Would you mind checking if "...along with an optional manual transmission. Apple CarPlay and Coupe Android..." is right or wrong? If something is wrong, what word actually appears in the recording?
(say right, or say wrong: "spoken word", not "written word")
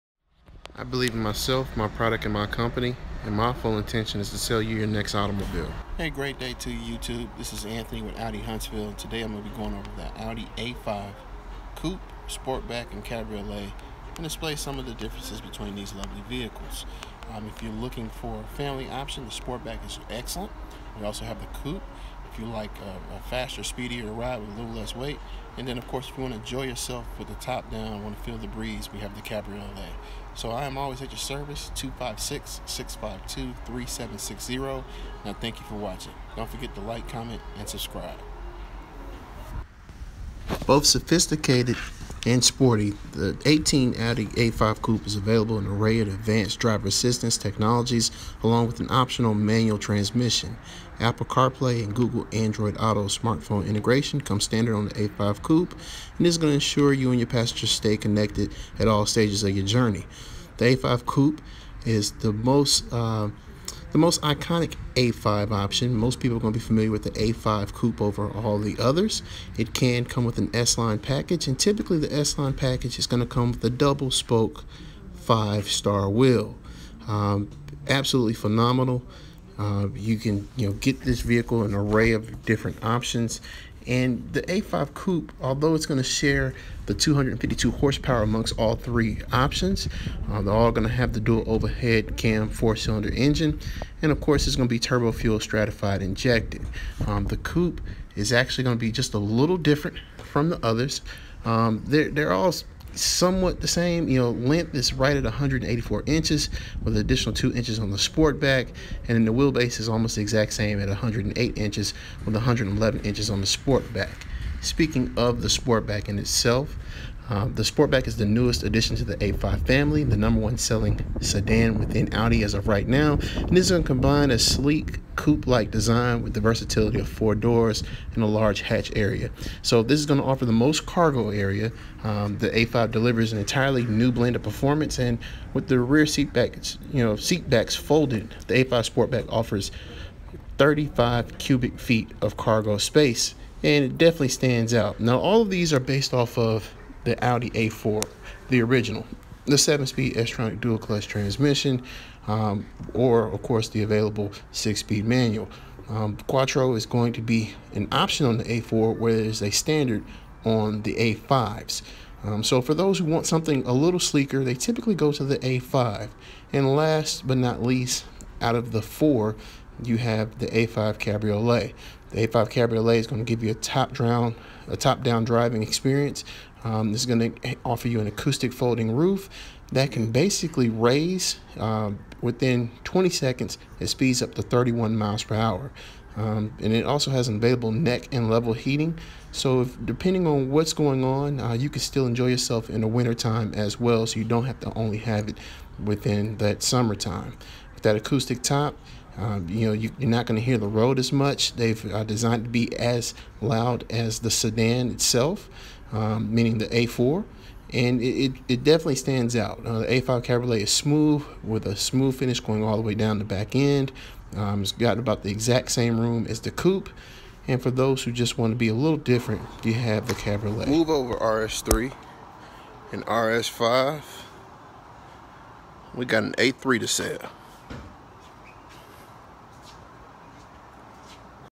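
wrong: "Google", not "Coupe".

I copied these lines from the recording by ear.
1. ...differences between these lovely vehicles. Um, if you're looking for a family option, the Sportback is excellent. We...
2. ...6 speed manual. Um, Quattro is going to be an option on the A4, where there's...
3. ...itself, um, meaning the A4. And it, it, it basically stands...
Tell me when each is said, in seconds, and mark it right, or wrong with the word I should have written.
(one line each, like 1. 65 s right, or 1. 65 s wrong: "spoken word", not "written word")
1. 14 s right
2. 154 s right
3. 204 s wrong: "definitely", not "basically".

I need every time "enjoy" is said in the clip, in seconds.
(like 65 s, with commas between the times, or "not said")
26 s, 192 s.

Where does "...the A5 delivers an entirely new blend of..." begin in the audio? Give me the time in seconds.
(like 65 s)
132 s.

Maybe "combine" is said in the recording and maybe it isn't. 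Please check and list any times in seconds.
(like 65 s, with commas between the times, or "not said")
123 s.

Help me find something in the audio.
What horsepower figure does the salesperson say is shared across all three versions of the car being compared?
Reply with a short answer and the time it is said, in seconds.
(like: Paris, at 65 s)
252, at 86 s.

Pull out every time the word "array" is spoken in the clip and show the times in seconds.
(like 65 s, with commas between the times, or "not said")
45 s, 81 s.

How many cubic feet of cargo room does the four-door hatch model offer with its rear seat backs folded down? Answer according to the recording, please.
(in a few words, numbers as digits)
35 cubic feet.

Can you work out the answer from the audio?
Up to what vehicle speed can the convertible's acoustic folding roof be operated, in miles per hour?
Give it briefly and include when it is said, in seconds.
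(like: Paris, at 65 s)
31 mph, at 184 s.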